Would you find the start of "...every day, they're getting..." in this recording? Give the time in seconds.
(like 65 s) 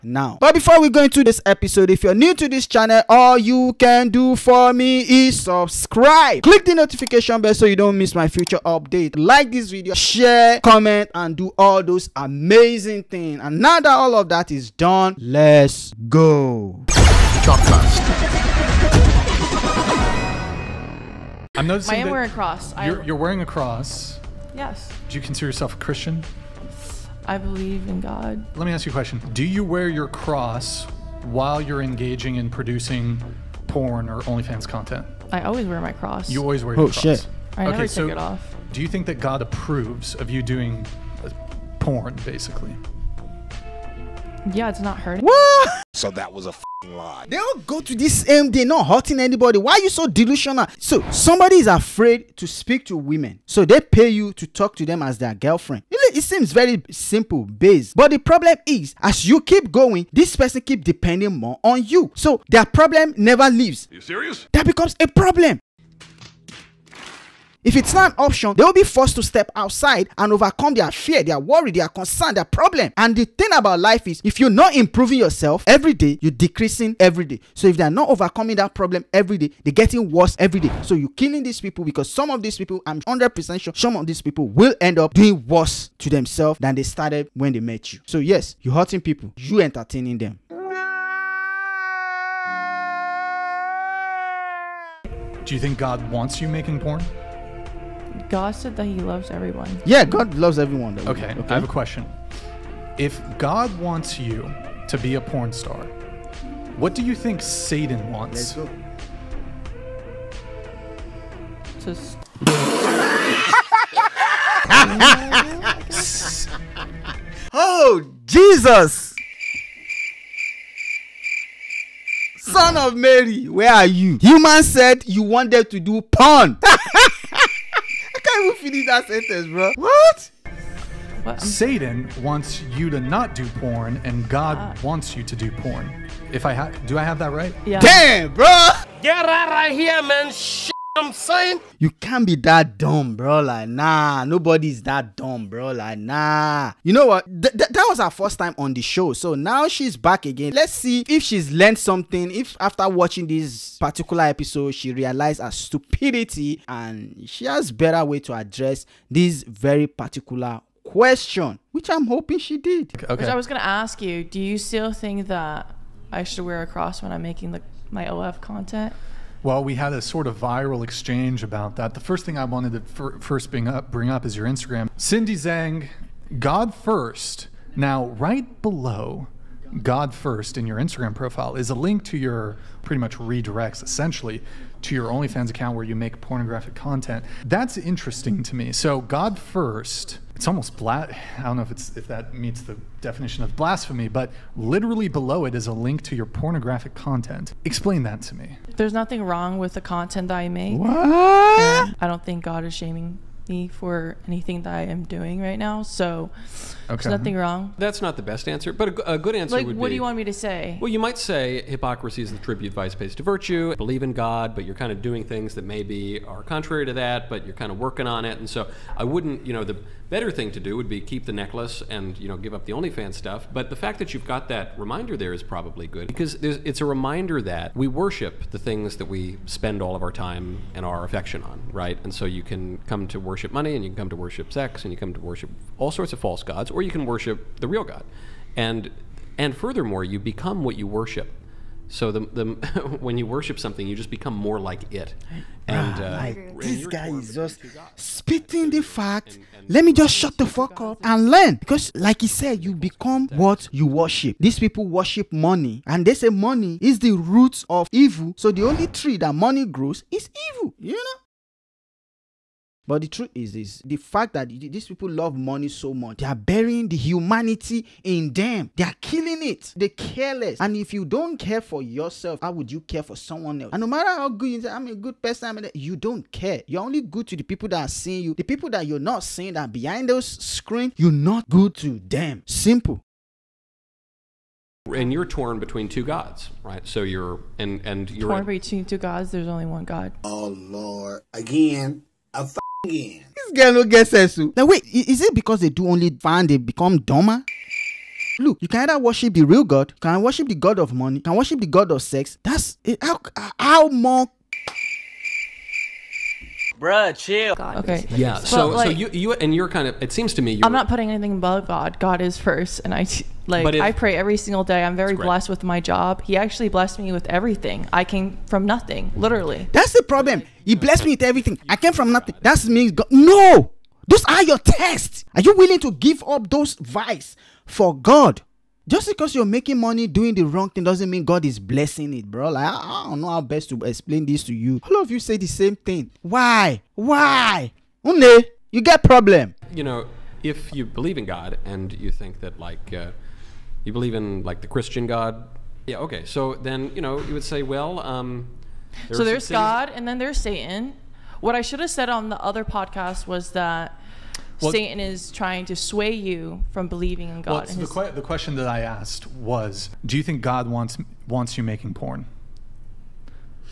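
79 s.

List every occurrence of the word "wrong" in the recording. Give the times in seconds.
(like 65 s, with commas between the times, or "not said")
199 s, 207 s, 330 s.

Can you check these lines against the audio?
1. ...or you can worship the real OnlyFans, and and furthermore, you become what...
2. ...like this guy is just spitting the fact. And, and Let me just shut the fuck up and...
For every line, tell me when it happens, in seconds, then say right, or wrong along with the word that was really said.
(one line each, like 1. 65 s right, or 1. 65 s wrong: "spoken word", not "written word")
1. 236 s wrong: "God", not "OnlyFans"
2. 246 s right.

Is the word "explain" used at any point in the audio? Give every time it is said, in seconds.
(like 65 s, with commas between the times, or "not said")
197 s, 333 s.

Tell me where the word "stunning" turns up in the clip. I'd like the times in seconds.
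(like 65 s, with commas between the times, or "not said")
not said.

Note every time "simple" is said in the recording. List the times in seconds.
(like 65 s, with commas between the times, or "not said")
56 s, 282 s.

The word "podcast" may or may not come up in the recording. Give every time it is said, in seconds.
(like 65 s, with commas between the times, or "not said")
352 s.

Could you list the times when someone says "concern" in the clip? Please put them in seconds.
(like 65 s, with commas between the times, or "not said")
71 s.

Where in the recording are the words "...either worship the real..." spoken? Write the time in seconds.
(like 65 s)
298 s.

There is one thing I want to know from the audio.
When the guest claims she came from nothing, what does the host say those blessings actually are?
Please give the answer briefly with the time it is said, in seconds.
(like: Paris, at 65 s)
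Tests, at 324 s.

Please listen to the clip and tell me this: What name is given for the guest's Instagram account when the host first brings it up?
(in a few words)
Cindy Zhang.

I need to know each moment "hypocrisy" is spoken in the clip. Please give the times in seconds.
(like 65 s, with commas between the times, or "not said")
211 s.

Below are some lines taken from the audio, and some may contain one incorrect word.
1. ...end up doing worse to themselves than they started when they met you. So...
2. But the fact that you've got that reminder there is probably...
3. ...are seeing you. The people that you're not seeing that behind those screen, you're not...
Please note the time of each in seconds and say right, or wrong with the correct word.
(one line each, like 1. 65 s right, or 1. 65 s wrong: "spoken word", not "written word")
1. 84 s right
2. 223 s right
3. 277 s right.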